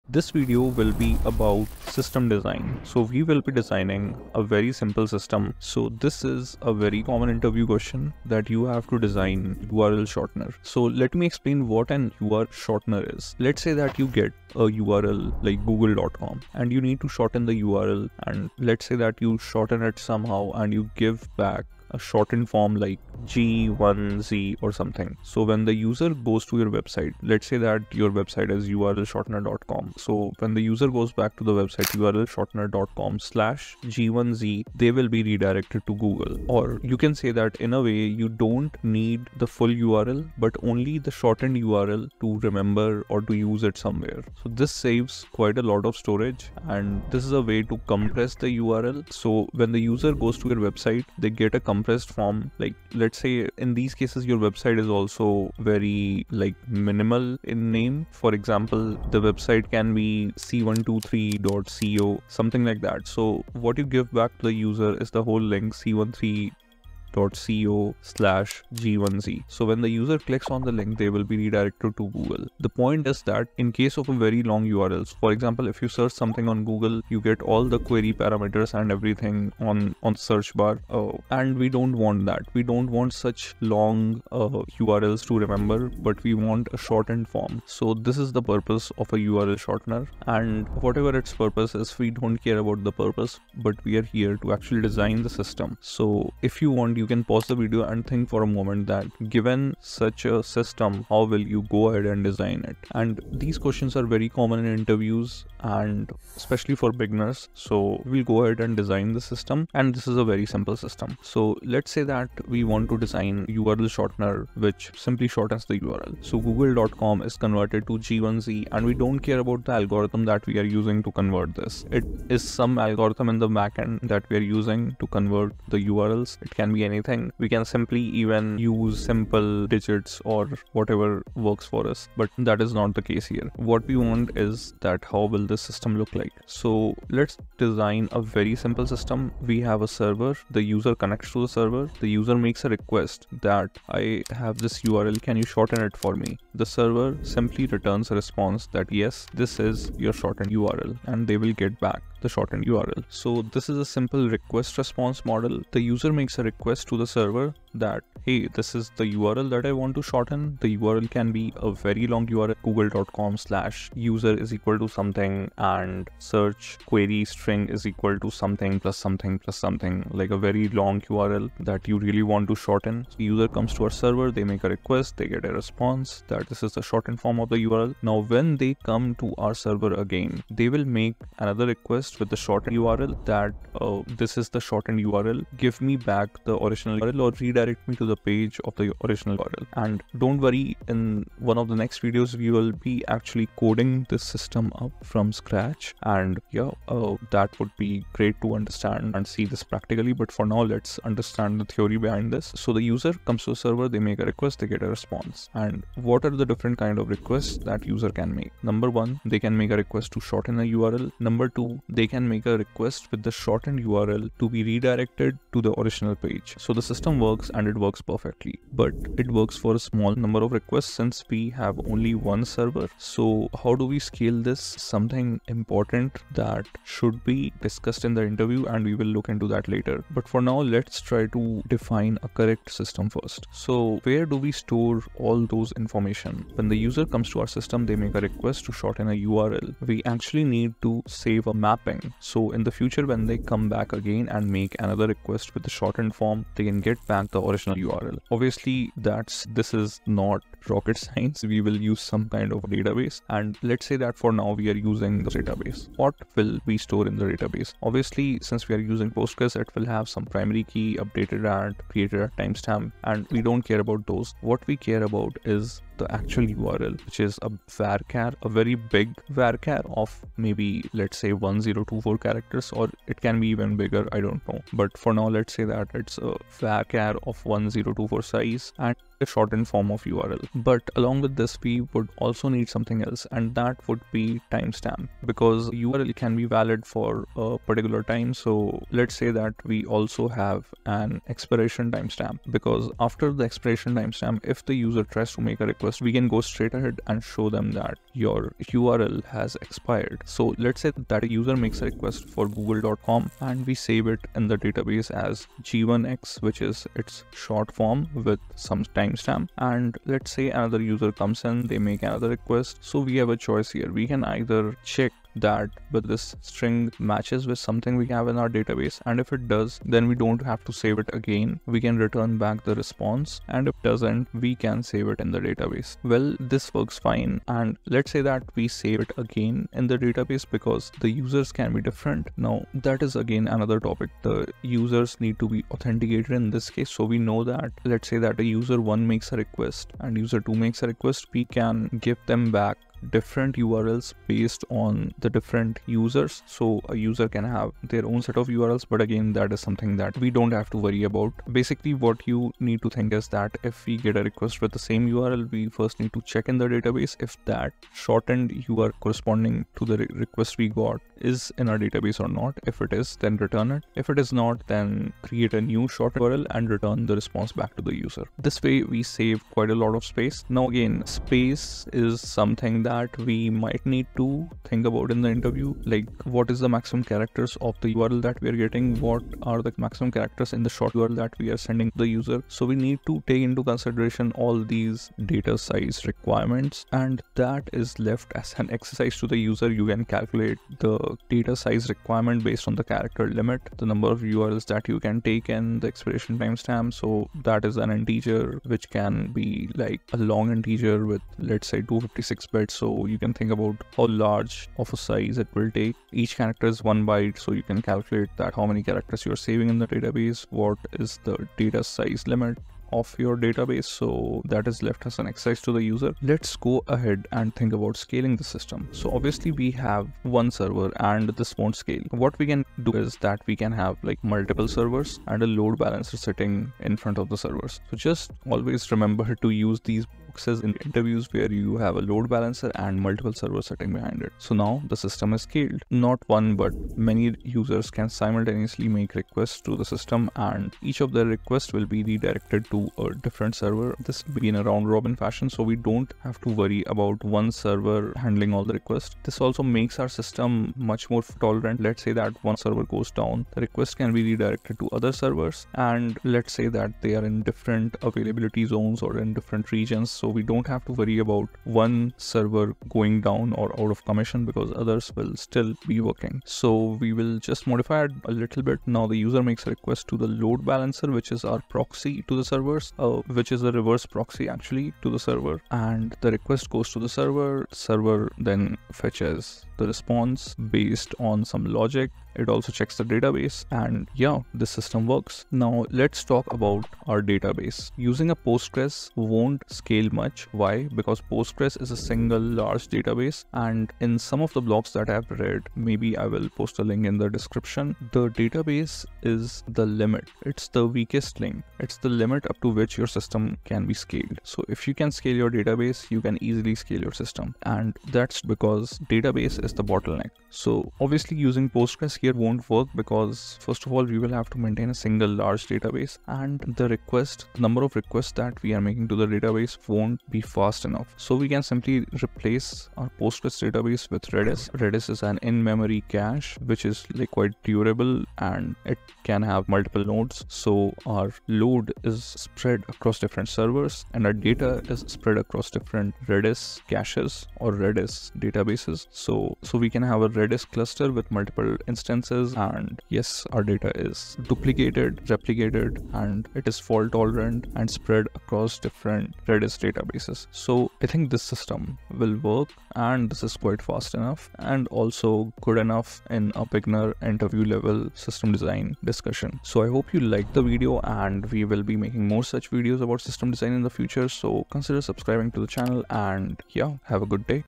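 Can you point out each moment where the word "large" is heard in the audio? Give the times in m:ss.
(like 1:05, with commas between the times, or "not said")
6:44, 8:12, 8:35.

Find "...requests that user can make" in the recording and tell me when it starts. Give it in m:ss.
3:27.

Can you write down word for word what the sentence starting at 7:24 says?
This will be in a round robin fashion so we don't have to worry about one server handling all the requests.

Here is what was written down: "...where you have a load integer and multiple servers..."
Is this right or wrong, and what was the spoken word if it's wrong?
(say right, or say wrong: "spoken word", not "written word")
wrong: "balancer", not "integer".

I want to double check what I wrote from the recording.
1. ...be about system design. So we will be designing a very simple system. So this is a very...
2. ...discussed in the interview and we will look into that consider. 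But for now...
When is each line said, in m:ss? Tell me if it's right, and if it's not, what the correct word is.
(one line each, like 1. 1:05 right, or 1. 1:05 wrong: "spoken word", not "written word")
1. 0:00 right
2. 3:47 wrong: "later", not "consider".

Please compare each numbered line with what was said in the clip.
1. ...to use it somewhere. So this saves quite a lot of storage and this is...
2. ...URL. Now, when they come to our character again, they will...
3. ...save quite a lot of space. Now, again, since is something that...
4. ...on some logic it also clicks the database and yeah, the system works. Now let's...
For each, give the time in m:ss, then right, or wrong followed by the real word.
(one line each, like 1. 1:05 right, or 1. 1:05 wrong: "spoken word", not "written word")
1. 0:43 right
2. 2:57 wrong: "server", not "character"
3. 6:09 wrong: "space", not "since"
4. 8:01 wrong: "checks", not "clicks".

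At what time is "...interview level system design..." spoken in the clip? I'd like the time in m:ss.
9:17.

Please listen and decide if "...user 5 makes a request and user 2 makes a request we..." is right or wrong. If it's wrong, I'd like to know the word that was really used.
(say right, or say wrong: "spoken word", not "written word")
wrong: "1", not "5".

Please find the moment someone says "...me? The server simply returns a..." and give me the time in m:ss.
2:26.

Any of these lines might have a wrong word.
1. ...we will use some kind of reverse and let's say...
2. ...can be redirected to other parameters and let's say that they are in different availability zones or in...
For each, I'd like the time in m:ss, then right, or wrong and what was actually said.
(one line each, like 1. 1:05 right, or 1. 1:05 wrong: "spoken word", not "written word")
1. 4:11 wrong: "database", not "reverse"
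2. 7:33 wrong: "servers", not "parameters".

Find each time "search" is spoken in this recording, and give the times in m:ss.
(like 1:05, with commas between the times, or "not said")
1:15, 1:20, 2:46.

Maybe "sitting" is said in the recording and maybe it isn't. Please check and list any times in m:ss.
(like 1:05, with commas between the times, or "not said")
7:06, 7:13.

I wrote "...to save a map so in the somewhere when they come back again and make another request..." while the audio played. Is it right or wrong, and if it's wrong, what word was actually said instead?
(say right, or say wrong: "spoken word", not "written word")
wrong: "future", not "somewhere".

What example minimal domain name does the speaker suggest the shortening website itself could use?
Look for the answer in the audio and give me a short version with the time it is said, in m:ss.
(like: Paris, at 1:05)
c123.co, at 1:00.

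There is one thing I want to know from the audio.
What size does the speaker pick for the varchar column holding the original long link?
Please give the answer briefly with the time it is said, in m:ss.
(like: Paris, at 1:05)
1024 characters, at 4:31.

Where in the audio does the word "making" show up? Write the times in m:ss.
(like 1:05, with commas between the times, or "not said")
8:38, 9:22.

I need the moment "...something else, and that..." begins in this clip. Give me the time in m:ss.
4:42.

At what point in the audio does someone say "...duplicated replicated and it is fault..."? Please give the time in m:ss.
9:04.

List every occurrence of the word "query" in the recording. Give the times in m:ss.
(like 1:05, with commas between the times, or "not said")
1:17, 2:46.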